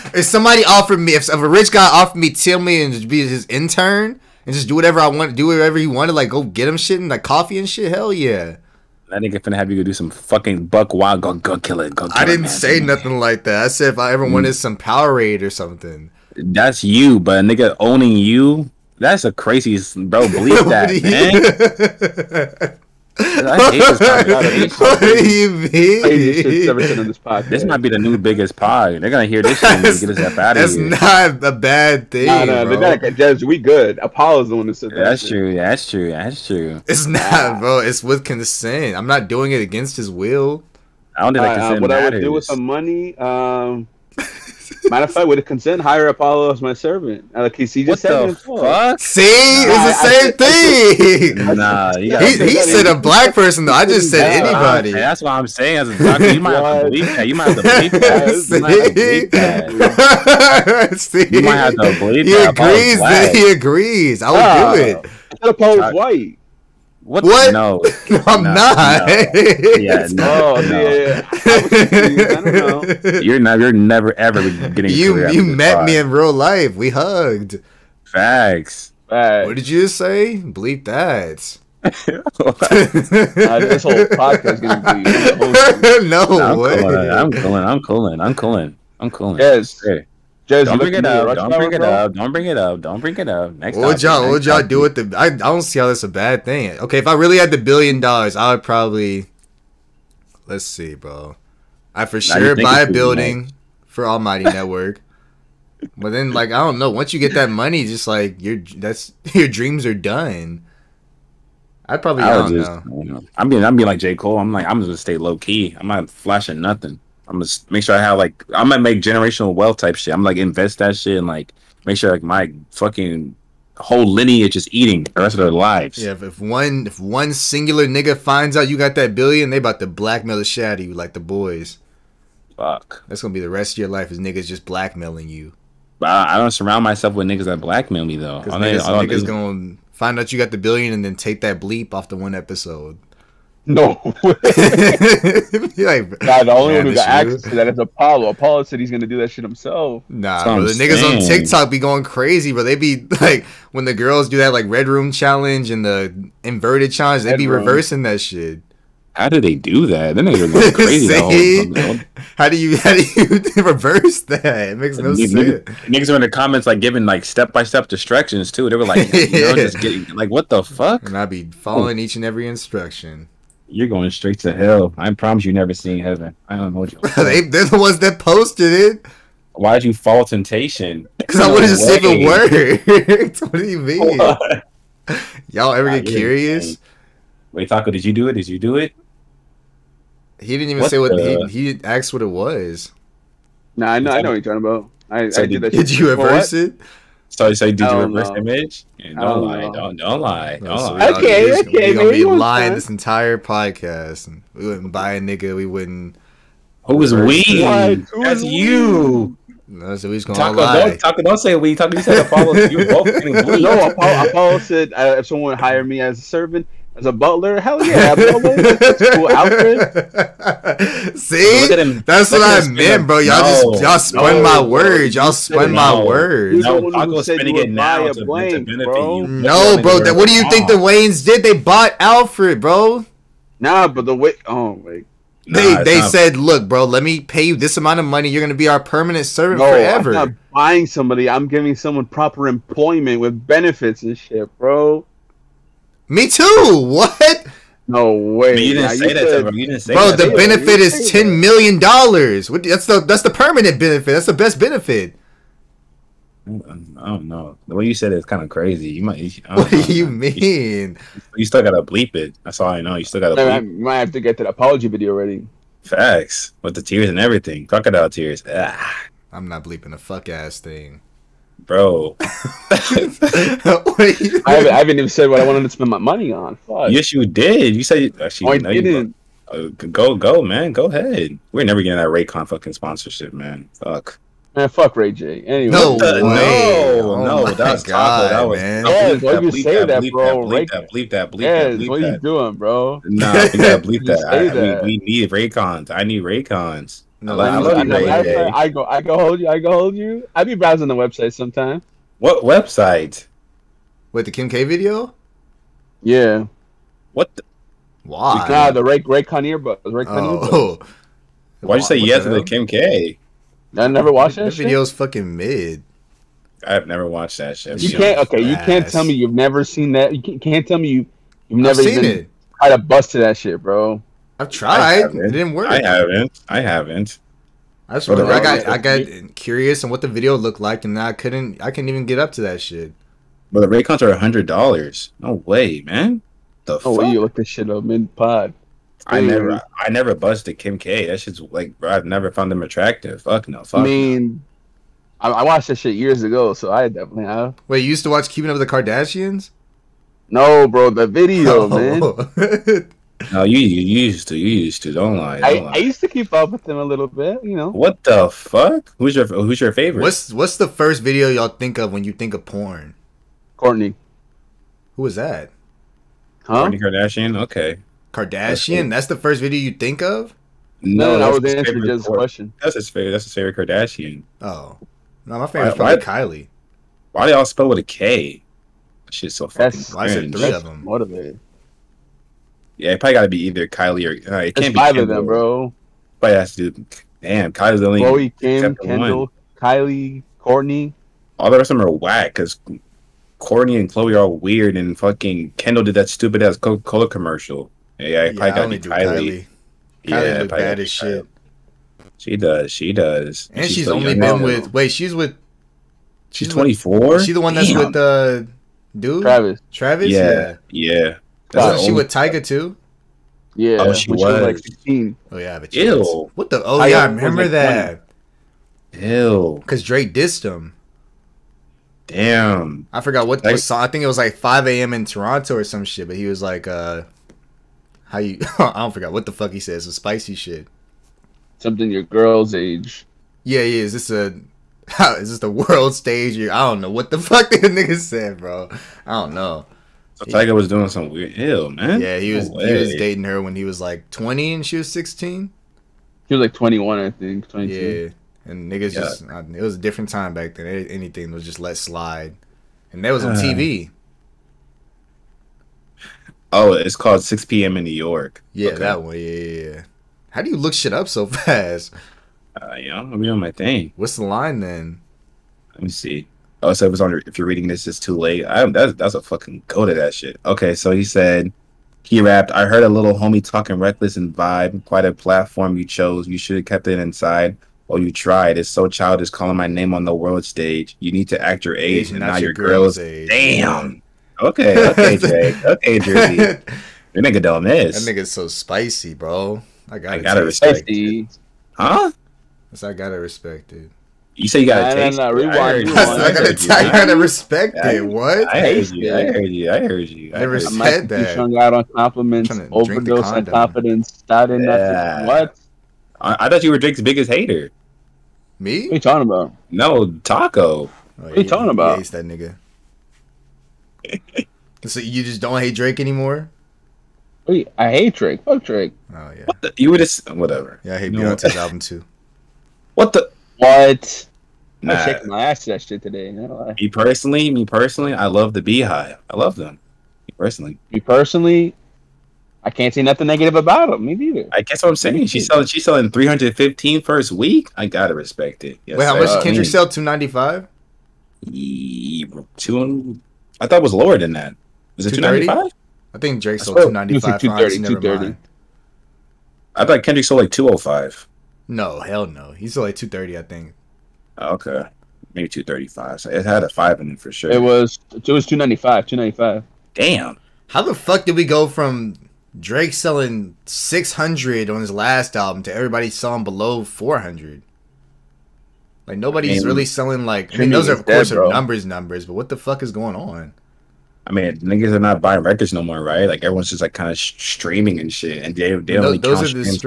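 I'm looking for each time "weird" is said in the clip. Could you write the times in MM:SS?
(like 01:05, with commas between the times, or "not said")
06:34, 07:21.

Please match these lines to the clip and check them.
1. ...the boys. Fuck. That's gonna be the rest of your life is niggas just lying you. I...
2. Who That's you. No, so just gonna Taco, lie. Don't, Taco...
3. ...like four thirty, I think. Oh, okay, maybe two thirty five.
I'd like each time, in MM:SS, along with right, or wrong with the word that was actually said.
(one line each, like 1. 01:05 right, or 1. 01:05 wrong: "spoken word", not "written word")
1. 02:11 wrong: "blackmailing", not "lying"
2. 03:27 right
3. 09:12 wrong: "two", not "four".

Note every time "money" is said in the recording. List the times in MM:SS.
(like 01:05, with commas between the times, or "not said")
00:42, 01:47, 03:58, 04:35.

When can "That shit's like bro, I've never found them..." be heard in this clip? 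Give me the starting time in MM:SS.
05:41.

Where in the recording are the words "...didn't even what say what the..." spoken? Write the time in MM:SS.
03:10.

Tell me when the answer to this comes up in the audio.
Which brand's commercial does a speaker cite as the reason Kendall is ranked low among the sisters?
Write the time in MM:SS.
06:36.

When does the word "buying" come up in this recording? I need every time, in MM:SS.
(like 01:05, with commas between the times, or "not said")
04:00, 09:35.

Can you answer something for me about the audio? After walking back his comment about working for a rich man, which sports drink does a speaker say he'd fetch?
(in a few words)
Powerade.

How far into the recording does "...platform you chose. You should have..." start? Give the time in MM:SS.
07:55.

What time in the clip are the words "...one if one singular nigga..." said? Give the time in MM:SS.
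02:06.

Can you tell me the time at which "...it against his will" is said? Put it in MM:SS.
00:39.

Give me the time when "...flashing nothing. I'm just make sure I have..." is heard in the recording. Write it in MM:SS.
01:56.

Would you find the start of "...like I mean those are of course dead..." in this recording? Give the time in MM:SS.
09:30.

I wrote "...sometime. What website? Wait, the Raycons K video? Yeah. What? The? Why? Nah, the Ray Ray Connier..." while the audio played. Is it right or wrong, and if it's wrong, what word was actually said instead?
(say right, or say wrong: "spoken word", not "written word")
wrong: "Kim", not "Raycons".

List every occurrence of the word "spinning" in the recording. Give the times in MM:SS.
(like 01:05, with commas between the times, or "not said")
03:47.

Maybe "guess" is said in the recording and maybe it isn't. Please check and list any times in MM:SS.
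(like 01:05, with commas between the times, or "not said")
08:54.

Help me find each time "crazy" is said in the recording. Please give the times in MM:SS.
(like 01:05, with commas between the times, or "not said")
00:19, 02:32, 02:40, 04:18.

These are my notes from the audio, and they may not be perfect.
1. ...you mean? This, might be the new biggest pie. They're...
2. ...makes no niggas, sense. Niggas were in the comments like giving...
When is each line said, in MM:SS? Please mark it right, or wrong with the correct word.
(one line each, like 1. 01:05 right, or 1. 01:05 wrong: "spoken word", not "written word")
1. 00:25 right
2. 02:44 right.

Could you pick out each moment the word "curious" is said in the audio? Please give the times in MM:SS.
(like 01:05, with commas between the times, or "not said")
03:06, 05:29.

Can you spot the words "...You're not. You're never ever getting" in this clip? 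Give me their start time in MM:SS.
01:13.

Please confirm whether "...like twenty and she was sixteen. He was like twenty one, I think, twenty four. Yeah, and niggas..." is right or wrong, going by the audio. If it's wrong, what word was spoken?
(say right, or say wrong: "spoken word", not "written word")
wrong: "two", not "four".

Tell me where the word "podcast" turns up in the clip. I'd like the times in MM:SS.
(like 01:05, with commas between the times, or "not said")
01:24, 03:23.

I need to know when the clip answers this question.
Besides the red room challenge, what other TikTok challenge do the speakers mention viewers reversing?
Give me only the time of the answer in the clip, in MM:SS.
02:36.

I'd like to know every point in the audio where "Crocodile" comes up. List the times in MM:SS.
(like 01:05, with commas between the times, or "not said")
04:27.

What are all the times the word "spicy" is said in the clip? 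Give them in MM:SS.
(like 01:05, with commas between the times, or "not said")
07:09, 08:08.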